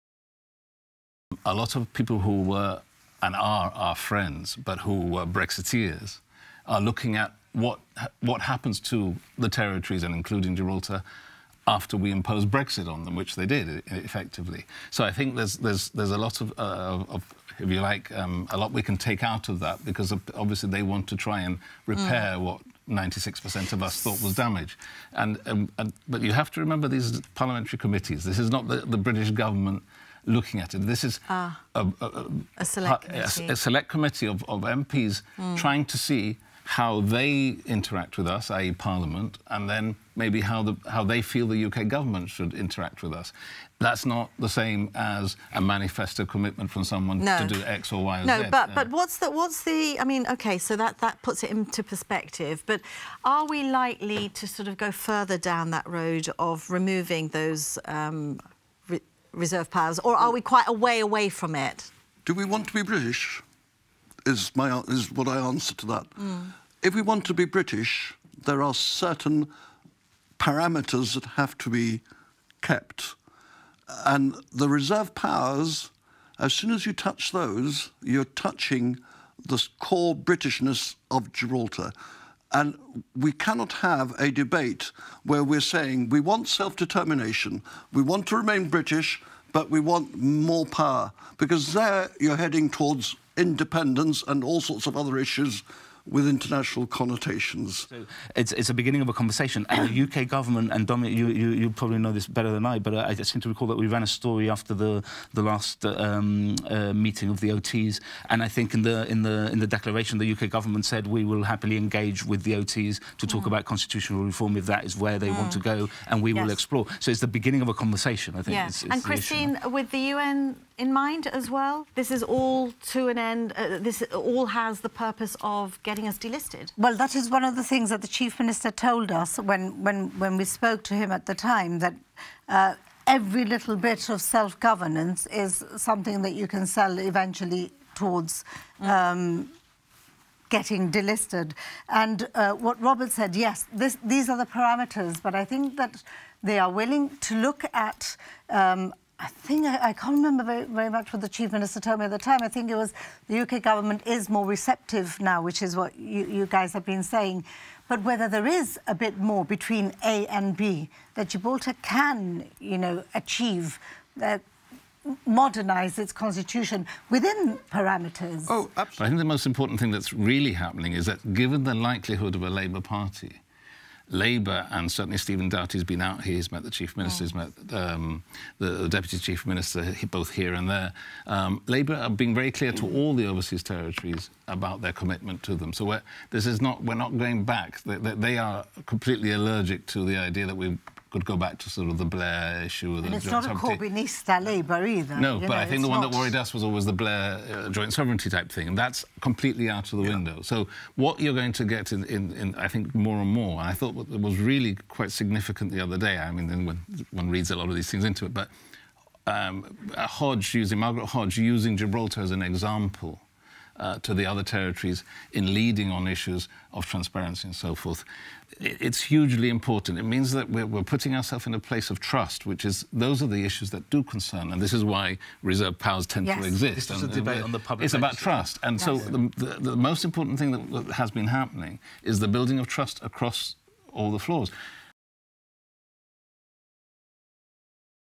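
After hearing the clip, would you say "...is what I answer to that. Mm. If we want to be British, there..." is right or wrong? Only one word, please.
right.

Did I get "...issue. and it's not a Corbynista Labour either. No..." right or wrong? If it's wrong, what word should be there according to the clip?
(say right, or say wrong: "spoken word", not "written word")
right.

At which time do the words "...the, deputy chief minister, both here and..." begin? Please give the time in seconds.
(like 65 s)
178 s.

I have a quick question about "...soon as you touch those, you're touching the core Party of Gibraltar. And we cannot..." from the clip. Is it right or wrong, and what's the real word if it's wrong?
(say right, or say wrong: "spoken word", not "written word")
wrong: "Britishness", not "Party".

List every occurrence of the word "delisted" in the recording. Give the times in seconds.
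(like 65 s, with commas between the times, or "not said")
126 s, 140 s.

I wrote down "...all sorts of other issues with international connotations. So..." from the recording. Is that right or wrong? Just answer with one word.
right.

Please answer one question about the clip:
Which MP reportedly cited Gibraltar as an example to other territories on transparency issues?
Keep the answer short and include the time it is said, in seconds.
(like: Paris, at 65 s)
Margaret Hodge, at 210 s.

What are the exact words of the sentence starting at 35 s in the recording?
trying to see how they interact with us, i.e.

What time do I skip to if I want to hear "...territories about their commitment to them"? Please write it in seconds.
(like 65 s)
183 s.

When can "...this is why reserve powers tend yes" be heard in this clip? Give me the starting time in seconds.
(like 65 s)
224 s.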